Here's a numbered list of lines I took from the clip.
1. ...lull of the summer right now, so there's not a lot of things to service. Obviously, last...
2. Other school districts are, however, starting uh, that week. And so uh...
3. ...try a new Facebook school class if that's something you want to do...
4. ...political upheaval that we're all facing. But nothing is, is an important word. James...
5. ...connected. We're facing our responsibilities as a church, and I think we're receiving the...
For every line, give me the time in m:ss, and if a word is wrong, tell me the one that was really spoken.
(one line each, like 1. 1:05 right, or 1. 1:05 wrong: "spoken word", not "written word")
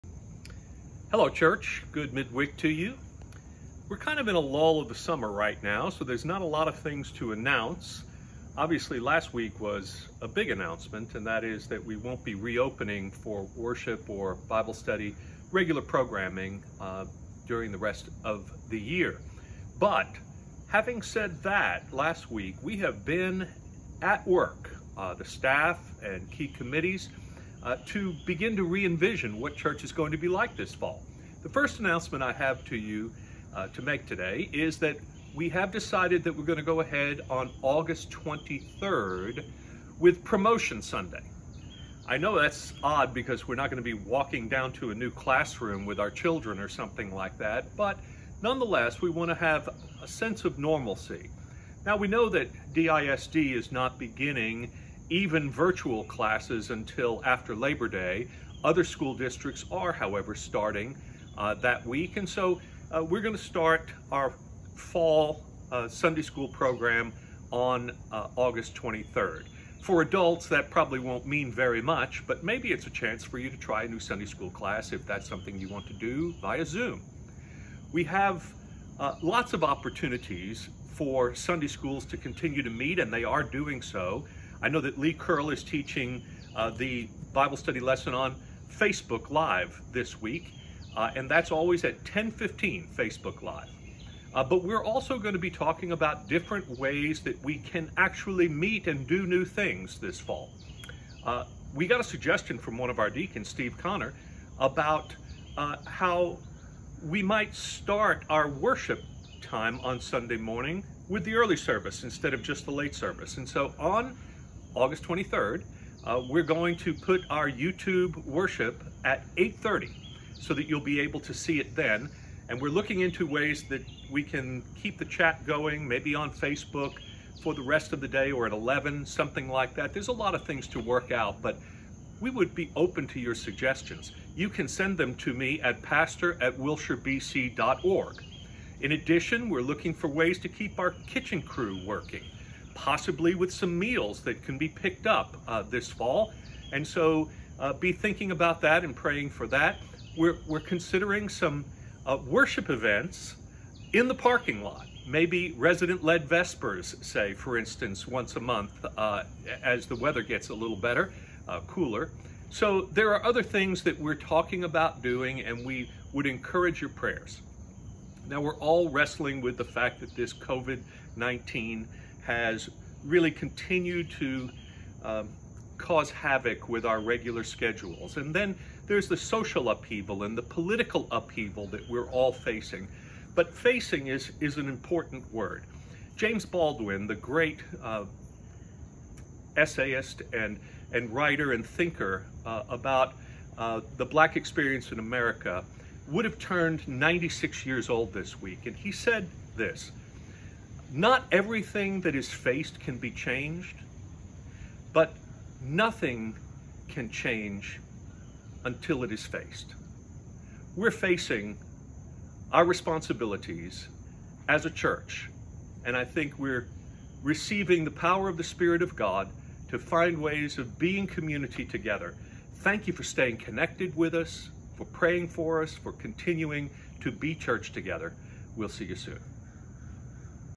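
1. 0:04 wrong: "announce", not "service"
2. 0:58 right
3. 1:13 wrong: "Sunday", not "Facebook"
4. 3:00 wrong: "facing", not "nothing"
5. 3:29 wrong: "faced", not "connected".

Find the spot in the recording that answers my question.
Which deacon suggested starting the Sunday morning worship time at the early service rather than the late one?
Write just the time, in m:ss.
1:43.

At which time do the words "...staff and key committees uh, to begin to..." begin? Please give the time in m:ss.
0:25.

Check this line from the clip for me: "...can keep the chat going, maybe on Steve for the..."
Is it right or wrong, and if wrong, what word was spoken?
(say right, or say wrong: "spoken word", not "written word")
wrong: "Facebook", not "Steve".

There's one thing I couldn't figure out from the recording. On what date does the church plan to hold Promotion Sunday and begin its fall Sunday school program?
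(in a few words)
August 23rd.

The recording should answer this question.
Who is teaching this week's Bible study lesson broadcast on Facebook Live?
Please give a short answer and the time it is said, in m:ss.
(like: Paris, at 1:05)
Lee Curl, at 1:24.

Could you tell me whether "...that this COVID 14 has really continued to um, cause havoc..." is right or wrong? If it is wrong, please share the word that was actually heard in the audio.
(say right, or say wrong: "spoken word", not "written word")
wrong: "19", not "14".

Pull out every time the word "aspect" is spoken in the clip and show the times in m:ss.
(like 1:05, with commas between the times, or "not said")
not said.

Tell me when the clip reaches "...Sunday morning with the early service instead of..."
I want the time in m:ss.
1:49.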